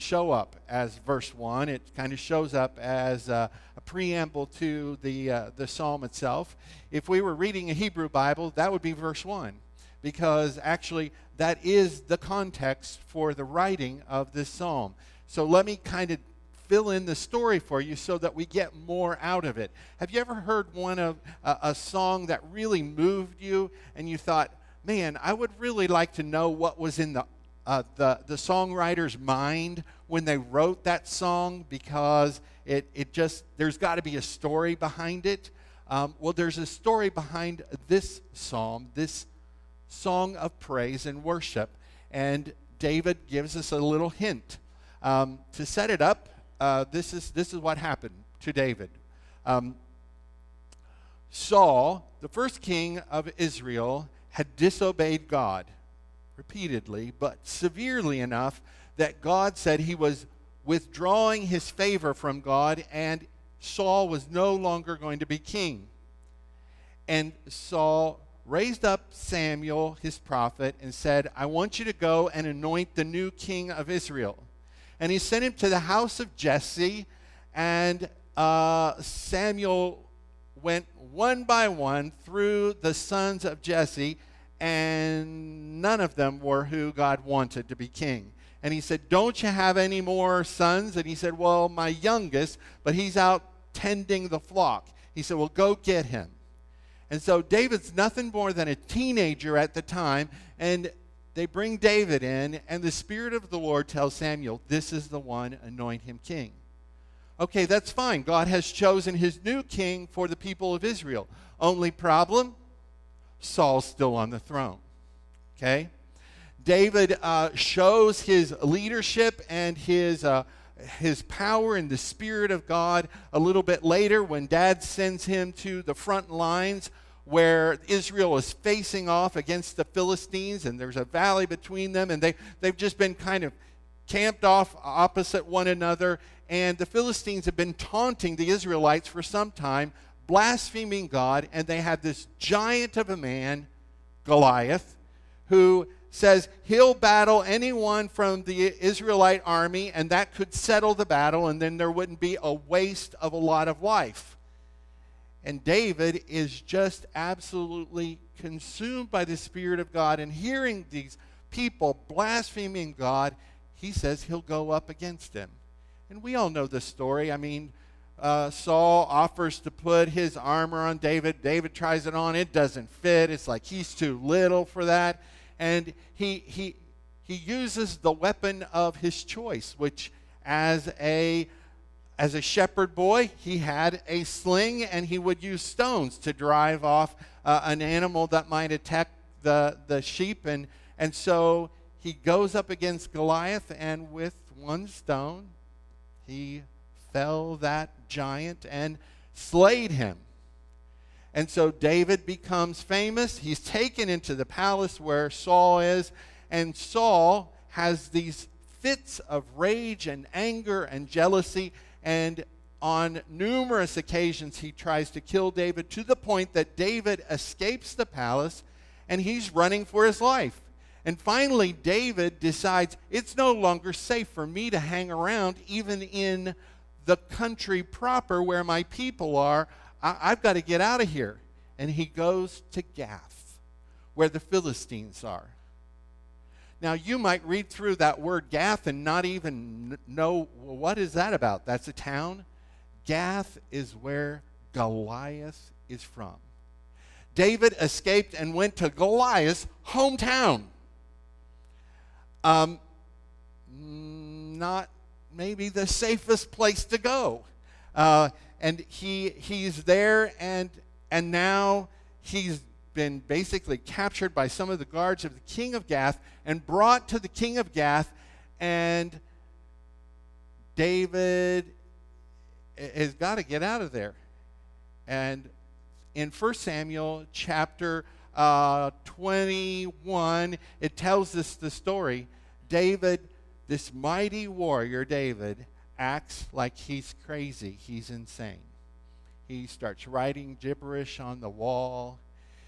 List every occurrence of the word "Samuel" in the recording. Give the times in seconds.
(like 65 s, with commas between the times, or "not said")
69 s, 79 s, 104 s, 276 s.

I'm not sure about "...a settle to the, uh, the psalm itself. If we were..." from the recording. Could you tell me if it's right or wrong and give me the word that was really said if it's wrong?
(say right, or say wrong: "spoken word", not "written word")
wrong: "preamble", not "settle".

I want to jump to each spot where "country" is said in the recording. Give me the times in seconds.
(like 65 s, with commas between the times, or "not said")
227 s.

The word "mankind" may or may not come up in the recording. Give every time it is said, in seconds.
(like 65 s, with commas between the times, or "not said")
not said.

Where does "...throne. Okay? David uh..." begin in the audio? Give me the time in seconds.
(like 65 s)
114 s.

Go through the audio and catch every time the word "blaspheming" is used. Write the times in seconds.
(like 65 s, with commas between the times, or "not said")
140 s, 162 s.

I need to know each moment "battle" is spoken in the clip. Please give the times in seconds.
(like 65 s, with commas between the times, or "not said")
146 s, 151 s.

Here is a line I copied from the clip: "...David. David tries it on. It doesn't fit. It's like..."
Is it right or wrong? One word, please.
right.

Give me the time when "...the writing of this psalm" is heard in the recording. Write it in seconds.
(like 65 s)
13 s.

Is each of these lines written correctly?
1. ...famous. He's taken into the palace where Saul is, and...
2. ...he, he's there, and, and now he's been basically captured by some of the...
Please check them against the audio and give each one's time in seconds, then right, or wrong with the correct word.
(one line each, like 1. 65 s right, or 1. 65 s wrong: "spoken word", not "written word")
1. 202 s right
2. 258 s right.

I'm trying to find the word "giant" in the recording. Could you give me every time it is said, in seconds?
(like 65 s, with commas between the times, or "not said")
142 s, 198 s.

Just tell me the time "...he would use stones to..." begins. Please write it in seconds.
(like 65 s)
185 s.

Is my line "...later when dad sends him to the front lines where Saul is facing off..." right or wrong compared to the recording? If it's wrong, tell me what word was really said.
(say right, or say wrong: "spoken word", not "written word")
wrong: "Israel", not "Saul".